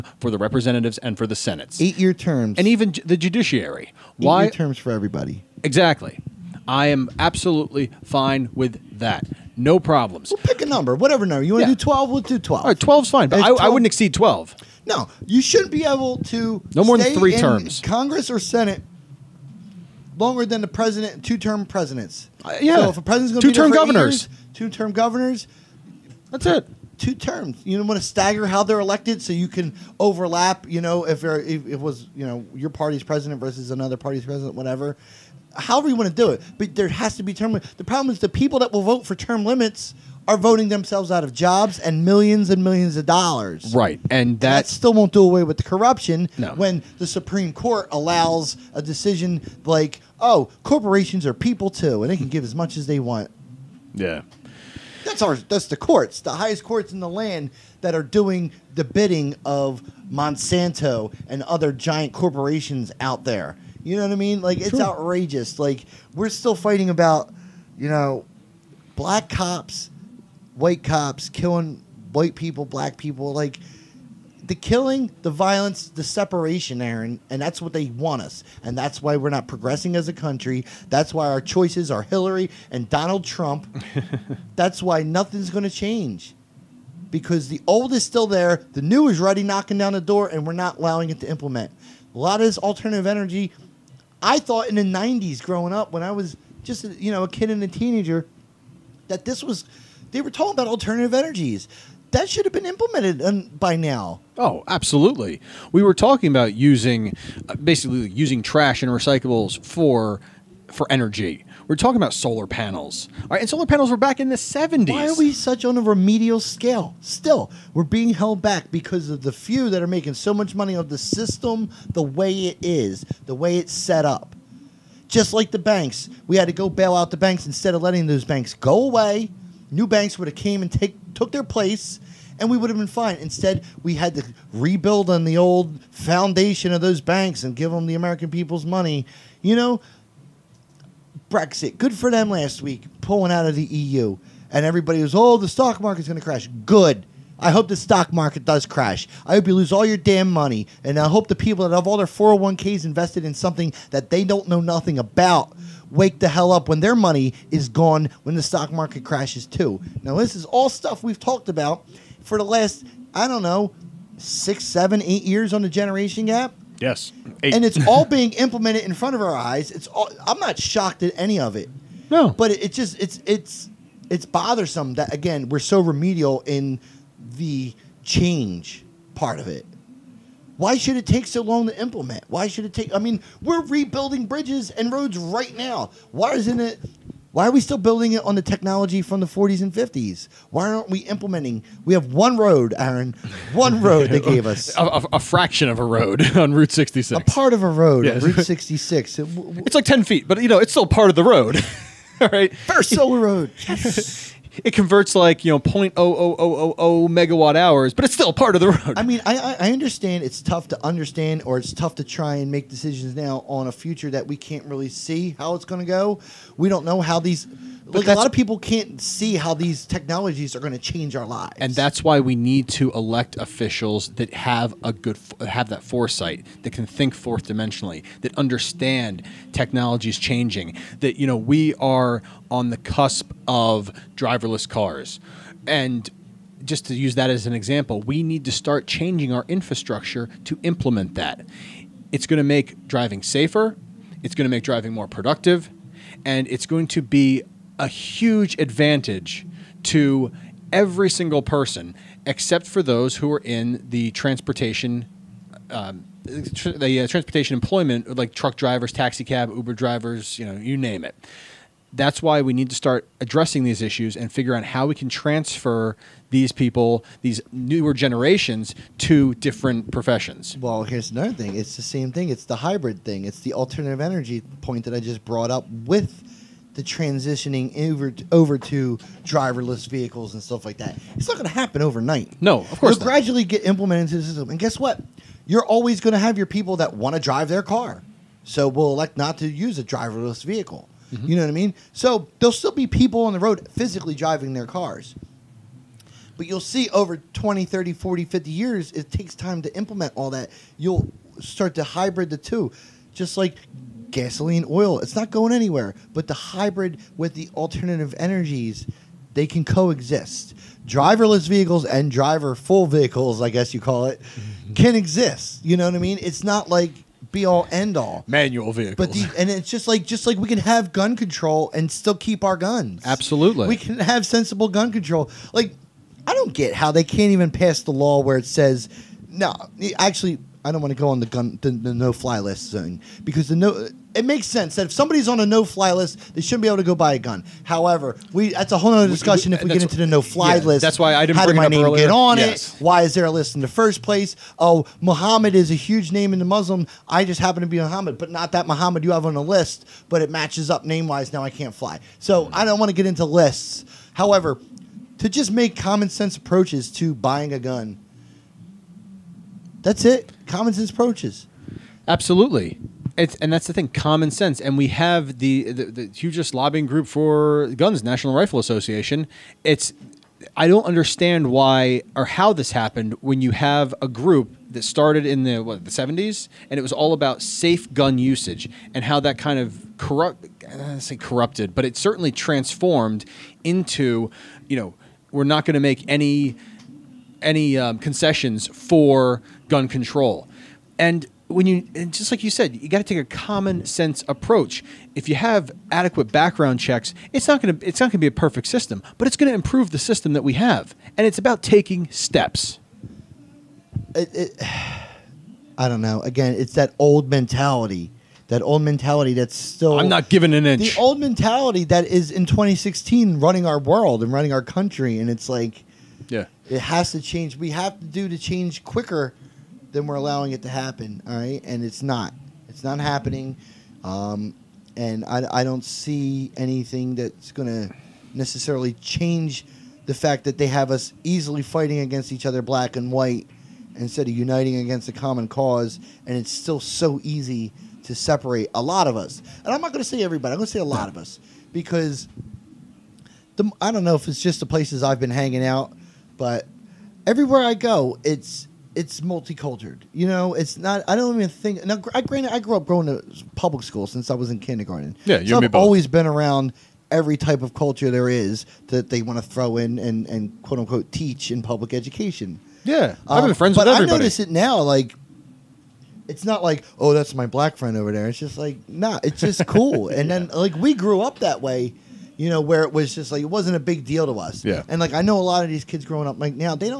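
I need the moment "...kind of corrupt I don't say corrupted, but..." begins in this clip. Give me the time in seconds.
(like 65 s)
379 s.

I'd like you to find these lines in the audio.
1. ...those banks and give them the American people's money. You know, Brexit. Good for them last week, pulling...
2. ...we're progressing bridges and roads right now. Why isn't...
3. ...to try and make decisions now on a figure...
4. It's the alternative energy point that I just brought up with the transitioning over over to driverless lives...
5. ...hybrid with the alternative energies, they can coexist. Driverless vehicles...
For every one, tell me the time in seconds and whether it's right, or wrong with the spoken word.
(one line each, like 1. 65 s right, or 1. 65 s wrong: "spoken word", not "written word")
1. 136 s right
2. 183 s wrong: "rebuilding", not "progressing"
3. 211 s wrong: "future", not "figure"
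4. 273 s wrong: "vehicles", not "lives"
5. 306 s right.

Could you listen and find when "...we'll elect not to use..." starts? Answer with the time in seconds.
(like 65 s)
288 s.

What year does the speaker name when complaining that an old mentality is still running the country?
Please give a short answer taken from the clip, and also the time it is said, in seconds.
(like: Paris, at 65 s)
2016, at 412 s.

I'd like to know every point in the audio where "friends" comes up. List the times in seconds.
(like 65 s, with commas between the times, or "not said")
463 s, 467 s.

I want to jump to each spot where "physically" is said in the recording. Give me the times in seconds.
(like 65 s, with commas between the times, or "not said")
293 s.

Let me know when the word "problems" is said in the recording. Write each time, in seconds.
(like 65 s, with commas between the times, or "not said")
9 s, 37 s.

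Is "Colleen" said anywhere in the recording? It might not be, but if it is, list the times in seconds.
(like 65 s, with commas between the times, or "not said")
not said.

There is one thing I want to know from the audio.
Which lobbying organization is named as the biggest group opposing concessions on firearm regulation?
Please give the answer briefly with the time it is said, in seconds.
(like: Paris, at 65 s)
National Rifle Association, at 368 s.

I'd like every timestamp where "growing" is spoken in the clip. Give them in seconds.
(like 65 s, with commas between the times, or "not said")
95 s, 476 s.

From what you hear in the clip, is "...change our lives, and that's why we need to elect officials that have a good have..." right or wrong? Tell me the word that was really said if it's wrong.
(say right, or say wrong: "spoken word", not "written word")
right.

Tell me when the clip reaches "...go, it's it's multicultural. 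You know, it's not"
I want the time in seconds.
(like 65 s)
447 s.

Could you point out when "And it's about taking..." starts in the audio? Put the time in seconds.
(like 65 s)
401 s.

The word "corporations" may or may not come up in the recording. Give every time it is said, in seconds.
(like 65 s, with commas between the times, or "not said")
50 s, 62 s.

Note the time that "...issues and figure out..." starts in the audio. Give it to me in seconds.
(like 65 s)
263 s.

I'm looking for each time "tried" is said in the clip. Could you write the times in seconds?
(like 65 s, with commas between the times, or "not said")
not said.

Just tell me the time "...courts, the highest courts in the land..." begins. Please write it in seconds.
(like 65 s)
55 s.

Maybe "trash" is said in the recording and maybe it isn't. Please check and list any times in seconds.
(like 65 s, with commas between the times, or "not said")
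108 s.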